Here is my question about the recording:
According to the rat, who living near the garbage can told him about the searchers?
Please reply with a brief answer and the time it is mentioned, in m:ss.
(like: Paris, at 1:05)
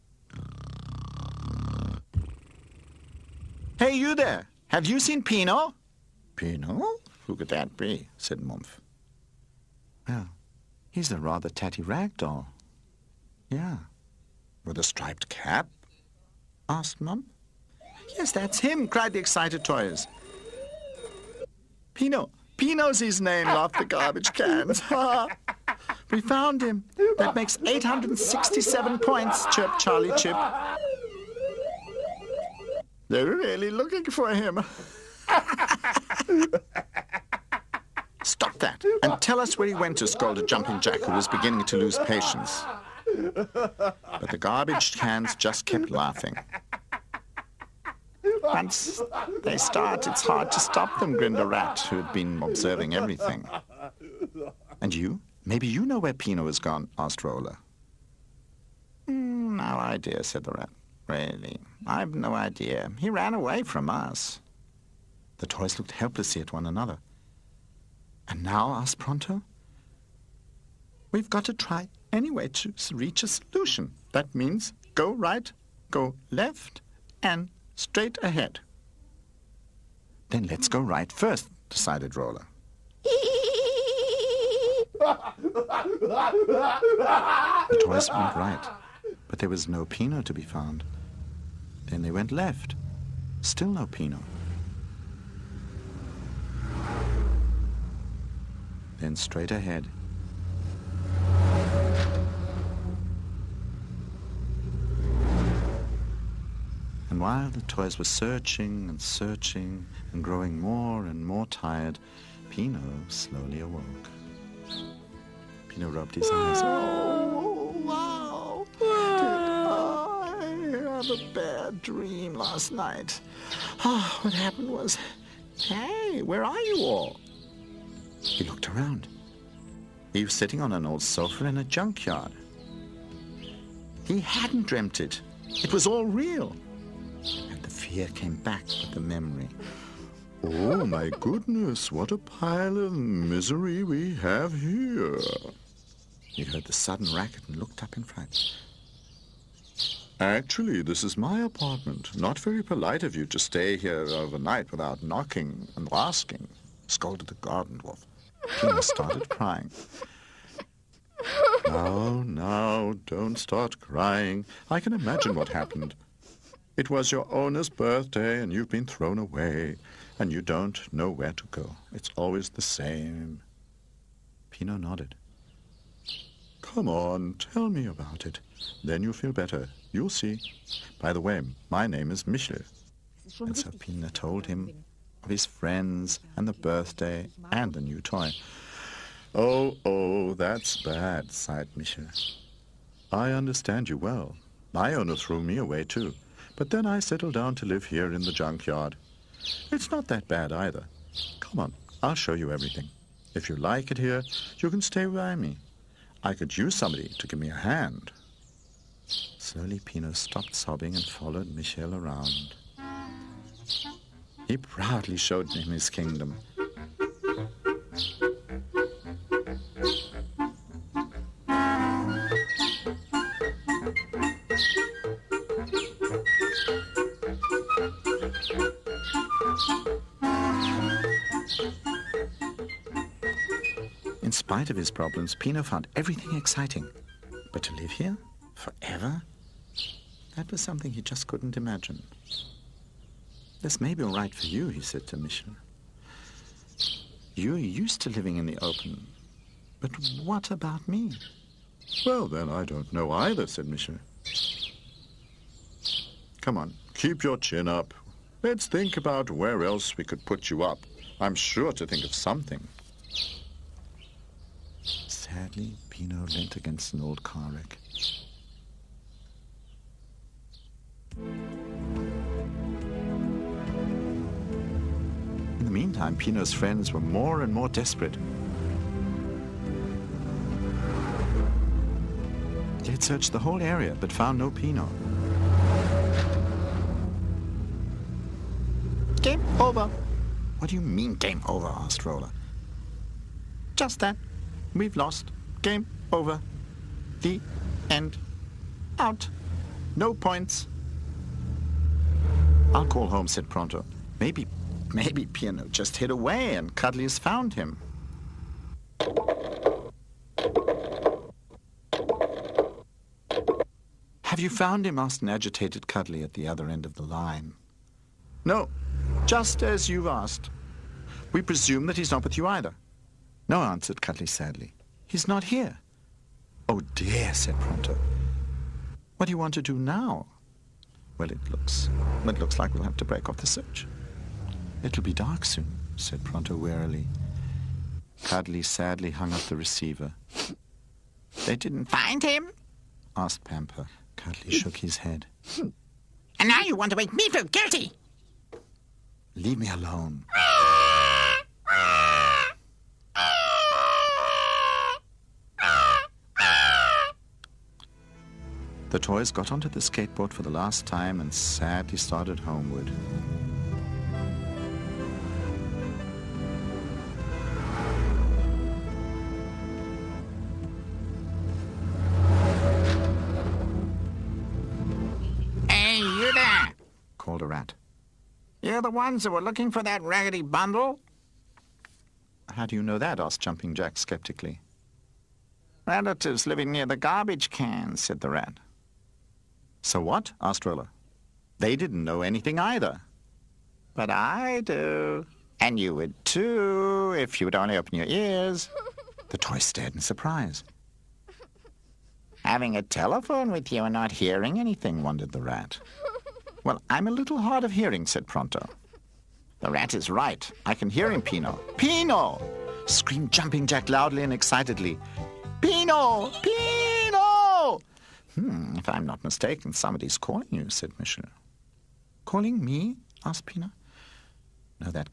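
Relatives, at 6:25.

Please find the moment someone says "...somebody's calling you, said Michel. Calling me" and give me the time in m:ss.
6:59.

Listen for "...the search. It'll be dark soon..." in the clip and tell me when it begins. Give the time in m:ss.
5:33.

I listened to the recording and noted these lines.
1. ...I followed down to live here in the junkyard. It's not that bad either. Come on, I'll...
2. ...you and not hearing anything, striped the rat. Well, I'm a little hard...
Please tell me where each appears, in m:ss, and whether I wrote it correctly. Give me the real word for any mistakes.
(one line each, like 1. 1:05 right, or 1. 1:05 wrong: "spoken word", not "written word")
1. 3:16 wrong: "settled", not "followed"
2. 6:43 wrong: "wondered", not "striped".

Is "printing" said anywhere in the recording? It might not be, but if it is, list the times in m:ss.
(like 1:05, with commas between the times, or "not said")
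not said.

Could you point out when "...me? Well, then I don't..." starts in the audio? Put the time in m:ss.
4:10.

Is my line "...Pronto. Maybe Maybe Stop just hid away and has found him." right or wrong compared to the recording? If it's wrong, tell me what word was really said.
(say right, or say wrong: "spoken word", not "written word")
wrong: "Pino", not "Stop".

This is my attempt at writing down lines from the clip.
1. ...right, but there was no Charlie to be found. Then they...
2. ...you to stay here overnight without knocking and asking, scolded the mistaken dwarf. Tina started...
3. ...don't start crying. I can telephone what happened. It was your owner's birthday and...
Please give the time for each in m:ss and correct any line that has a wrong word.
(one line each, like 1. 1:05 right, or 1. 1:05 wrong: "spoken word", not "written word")
1. 1:28 wrong: "Pino", not "Charlie"
2. 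2:33 wrong: "garden", not "mistaken"
3. 2:43 wrong: "imagine", not "telephone".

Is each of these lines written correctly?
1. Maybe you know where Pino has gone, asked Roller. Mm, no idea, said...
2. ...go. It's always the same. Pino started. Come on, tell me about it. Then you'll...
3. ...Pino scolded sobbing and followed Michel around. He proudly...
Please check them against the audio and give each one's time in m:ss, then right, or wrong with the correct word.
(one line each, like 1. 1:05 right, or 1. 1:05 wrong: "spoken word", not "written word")
1. 0:55 right
2. 2:51 wrong: "nodded", not "started"
3. 3:29 wrong: "stopped", not "scolded".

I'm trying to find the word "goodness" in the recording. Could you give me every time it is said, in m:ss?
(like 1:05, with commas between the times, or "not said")
2:21.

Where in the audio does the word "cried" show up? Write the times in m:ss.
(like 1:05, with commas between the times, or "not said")
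0:18.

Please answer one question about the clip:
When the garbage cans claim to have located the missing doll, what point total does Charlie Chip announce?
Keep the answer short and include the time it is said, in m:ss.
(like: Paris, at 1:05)
867, at 0:27.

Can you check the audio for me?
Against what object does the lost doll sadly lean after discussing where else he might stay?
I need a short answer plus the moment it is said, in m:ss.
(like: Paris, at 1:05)
An old car wreck, at 4:27.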